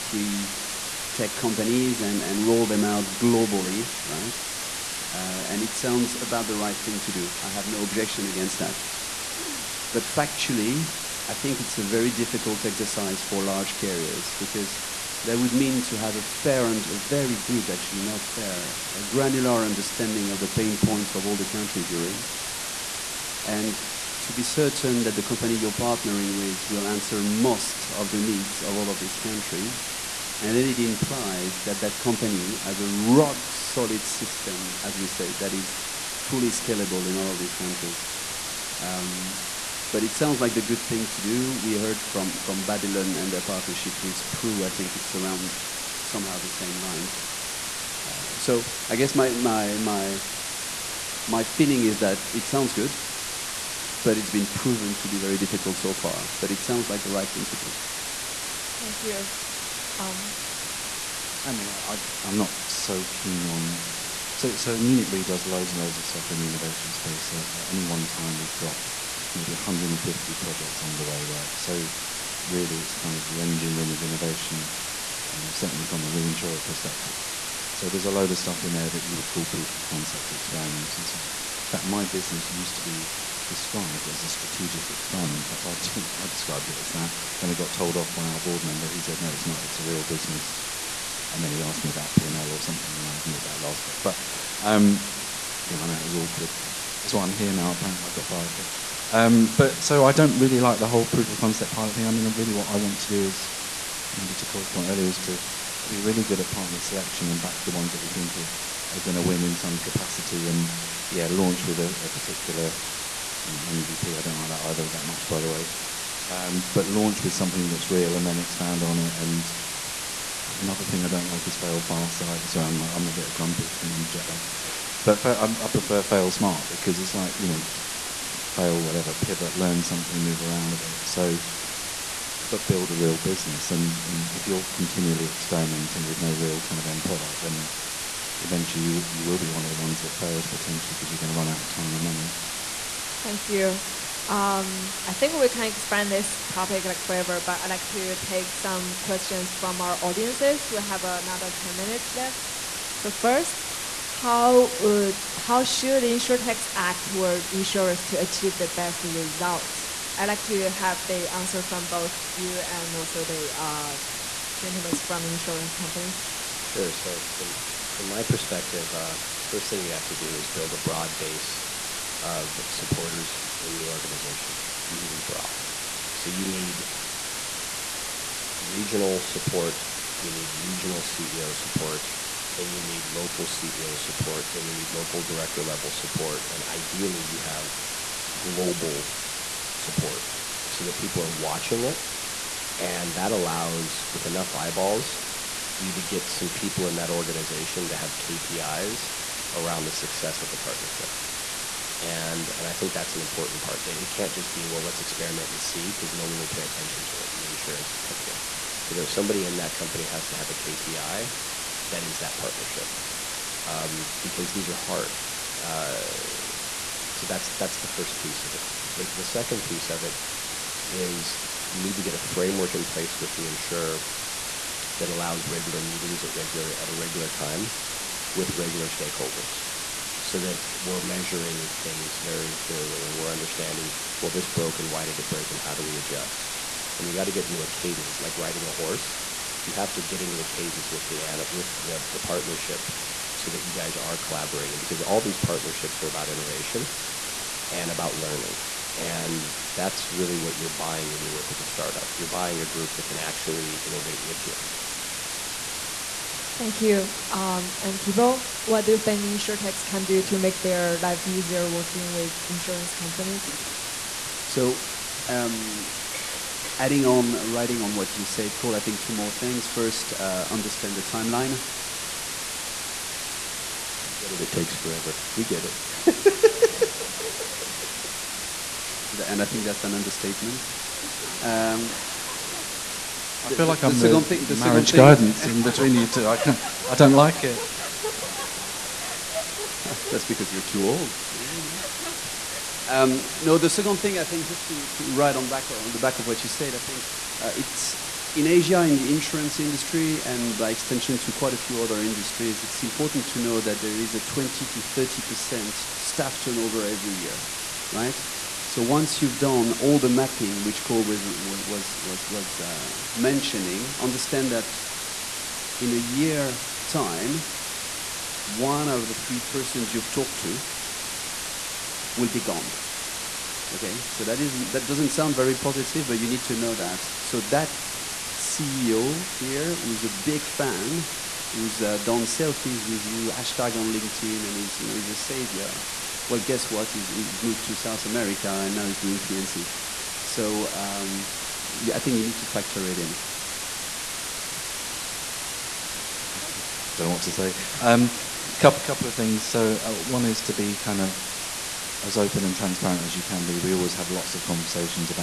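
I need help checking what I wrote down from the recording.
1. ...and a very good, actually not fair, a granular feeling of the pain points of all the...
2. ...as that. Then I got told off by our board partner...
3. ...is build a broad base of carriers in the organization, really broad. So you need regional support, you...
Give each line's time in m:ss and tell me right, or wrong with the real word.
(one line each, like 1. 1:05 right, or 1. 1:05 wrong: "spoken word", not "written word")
1. 0:16 wrong: "understanding", not "feeling"
2. 1:26 wrong: "member", not "partner"
3. 2:50 wrong: "supporters", not "carriers".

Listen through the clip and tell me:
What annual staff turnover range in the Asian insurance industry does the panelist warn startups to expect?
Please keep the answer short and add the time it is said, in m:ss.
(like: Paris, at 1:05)
20 to 30 percent, at 5:04.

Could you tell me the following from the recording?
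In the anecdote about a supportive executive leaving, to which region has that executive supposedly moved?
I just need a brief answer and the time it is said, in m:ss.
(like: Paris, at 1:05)
South America, at 5:37.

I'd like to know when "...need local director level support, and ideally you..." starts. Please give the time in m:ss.
3:04.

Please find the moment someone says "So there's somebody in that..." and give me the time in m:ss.
3:28.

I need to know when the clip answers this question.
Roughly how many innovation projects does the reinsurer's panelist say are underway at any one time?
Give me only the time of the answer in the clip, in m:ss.
1:09.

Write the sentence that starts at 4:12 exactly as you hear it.
You're buying a group that can actually innovate with you.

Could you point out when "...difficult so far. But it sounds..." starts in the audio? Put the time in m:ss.
0:55.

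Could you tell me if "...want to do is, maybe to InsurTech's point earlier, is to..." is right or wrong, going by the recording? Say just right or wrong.
wrong.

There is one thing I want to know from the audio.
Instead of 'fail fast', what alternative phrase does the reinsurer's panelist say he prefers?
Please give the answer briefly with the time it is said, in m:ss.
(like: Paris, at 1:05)
fail smart, at 2:06.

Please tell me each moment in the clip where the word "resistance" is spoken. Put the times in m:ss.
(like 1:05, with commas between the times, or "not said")
not said.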